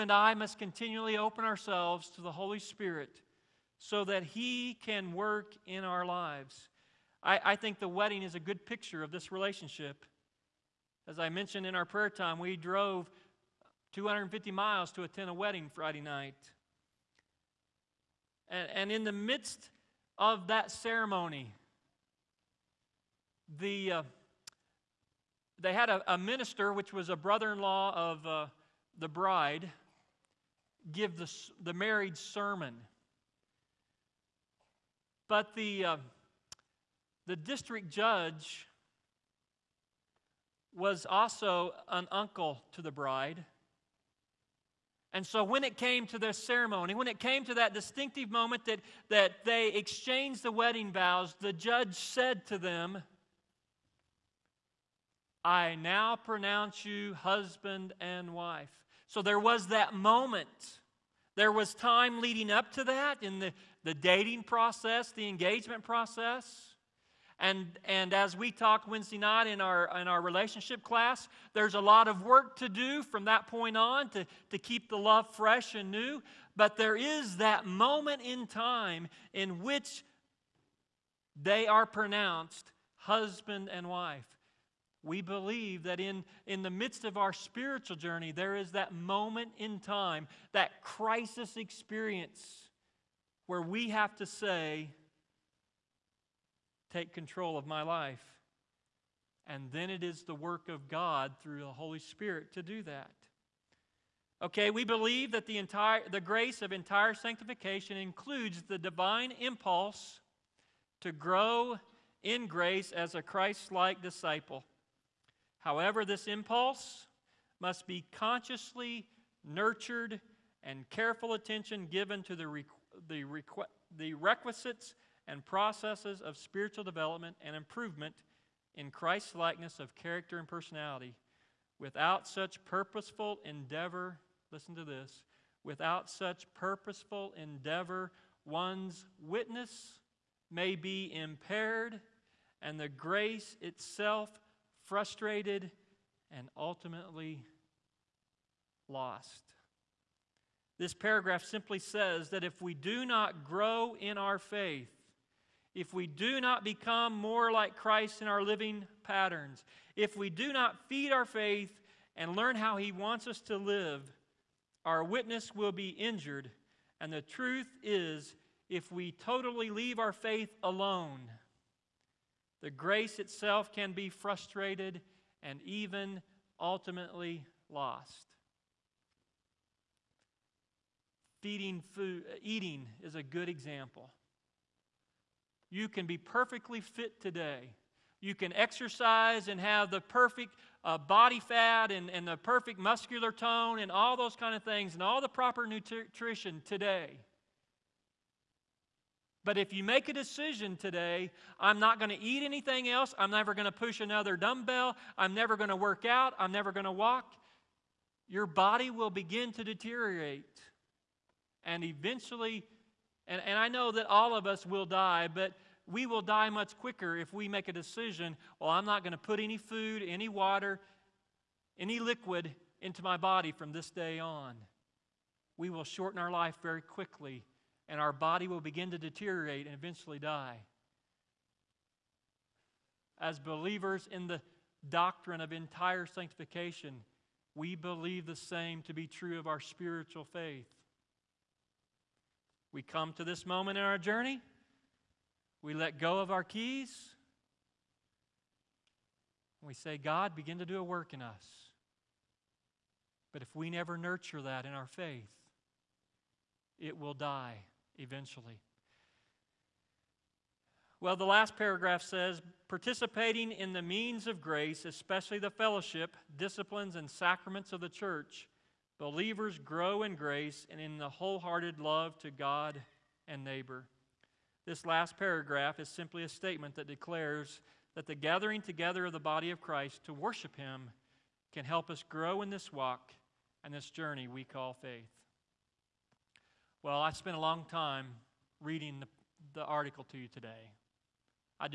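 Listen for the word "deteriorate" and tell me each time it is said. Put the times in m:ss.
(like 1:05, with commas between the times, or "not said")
3:29, 3:48.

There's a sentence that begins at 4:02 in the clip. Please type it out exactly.
We come to this moment in our journey.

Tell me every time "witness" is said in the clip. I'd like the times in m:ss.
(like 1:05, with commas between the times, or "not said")
2:19, 2:45.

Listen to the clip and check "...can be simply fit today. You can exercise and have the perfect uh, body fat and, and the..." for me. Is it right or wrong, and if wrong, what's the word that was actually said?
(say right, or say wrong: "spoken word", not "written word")
wrong: "perfectly", not "simply".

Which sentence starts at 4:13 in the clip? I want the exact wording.
But if we never nurture that in our faith, it will die eventually.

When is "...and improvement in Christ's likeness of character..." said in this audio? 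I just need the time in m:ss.
2:07.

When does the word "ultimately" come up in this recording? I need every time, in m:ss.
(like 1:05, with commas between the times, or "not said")
2:26, 2:56.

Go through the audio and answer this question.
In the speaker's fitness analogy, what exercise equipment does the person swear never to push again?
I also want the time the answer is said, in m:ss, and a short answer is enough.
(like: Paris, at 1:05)
Dumbbell, at 3:24.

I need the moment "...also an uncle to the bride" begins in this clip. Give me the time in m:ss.
0:41.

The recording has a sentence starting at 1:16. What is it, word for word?
But there is that moment in time in which they are pronounced husband and wife.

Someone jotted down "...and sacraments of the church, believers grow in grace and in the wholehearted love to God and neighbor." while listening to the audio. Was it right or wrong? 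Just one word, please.
right.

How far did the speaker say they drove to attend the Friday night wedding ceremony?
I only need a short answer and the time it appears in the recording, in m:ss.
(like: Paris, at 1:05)
250 miles, at 0:13.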